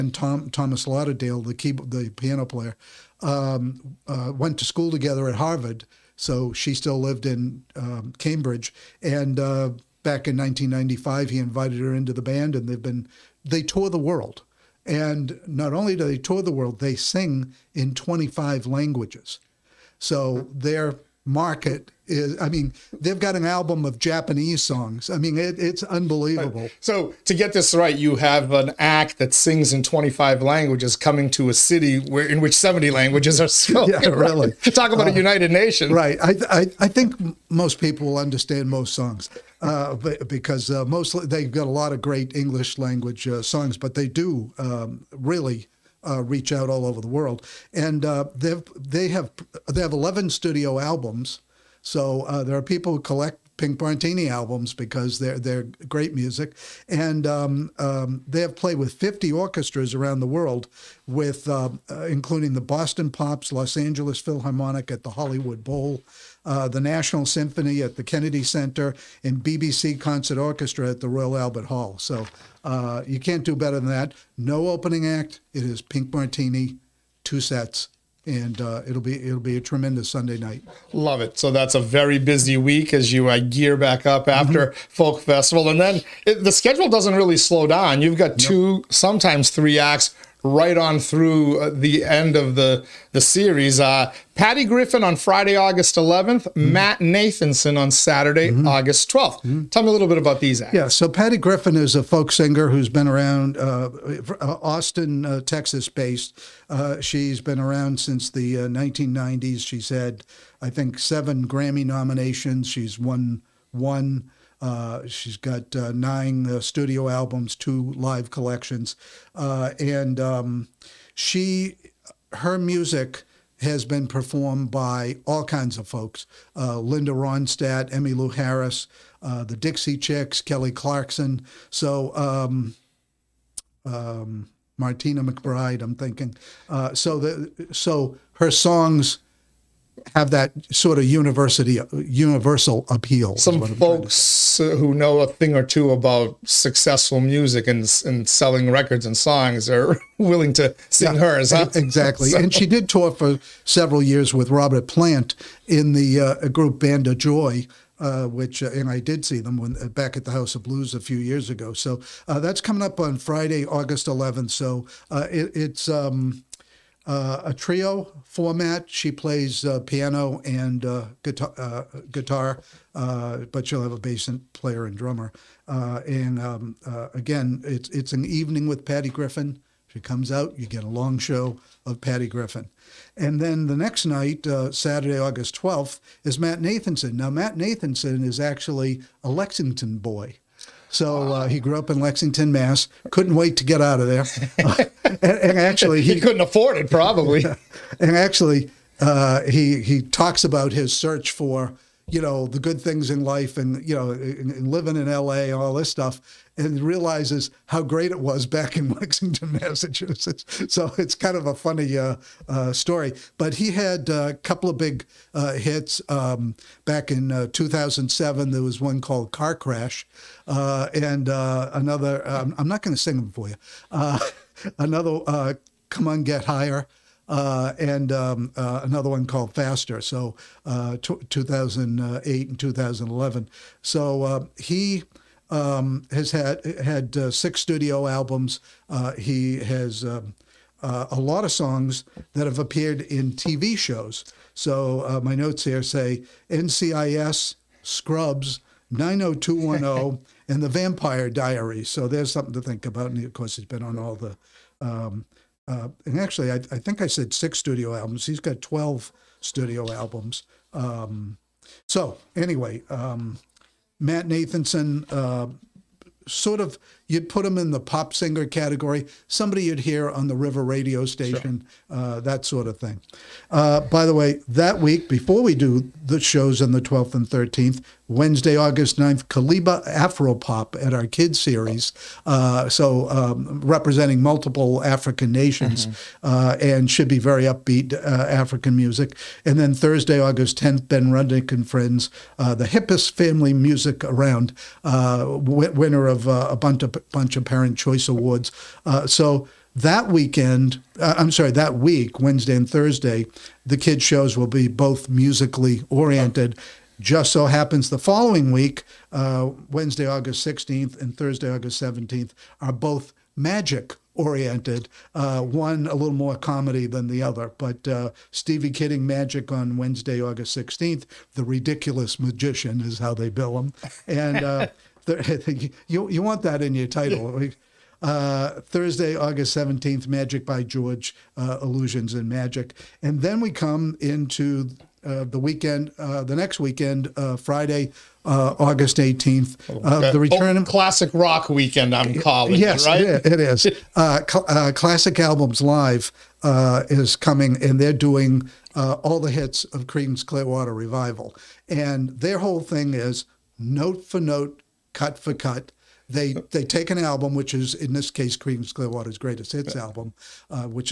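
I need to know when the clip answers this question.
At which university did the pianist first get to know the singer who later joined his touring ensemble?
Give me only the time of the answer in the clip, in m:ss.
0:05.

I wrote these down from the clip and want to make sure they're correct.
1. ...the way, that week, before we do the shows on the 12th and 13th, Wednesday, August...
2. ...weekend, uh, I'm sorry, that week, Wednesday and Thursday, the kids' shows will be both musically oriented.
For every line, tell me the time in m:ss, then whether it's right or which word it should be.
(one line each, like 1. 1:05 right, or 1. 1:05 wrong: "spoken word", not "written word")
1. 4:34 right
2. 5:00 right.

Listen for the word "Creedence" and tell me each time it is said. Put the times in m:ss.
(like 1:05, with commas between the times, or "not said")
5:49, 5:58.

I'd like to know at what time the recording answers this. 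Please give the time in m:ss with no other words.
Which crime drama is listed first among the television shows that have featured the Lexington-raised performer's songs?
4:06.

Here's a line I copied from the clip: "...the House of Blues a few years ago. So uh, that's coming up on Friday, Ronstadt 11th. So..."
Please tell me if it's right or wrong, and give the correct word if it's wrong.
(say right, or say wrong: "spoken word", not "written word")
wrong: "August", not "Ronstadt".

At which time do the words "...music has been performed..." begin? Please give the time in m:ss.
2:02.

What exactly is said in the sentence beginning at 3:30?
So it's kind of a funny uh, uh, story.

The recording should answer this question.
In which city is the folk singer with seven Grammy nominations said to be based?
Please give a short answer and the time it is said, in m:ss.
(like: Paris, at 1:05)
Austin, at 1:44.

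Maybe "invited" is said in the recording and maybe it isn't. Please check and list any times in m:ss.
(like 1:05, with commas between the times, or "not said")
0:11.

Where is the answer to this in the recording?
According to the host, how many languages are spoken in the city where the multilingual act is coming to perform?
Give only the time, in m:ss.
0:32.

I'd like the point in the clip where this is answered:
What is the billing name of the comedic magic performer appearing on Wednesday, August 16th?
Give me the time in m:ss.
5:21.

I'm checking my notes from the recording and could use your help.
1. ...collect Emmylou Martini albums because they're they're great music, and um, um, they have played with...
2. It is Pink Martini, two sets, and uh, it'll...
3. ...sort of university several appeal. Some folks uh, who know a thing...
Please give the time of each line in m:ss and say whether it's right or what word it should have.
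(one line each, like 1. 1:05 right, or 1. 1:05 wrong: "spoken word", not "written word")
1. 0:52 wrong: "Pink", not "Emmylou"
2. 1:15 right
3. 2:20 wrong: "universal", not "several".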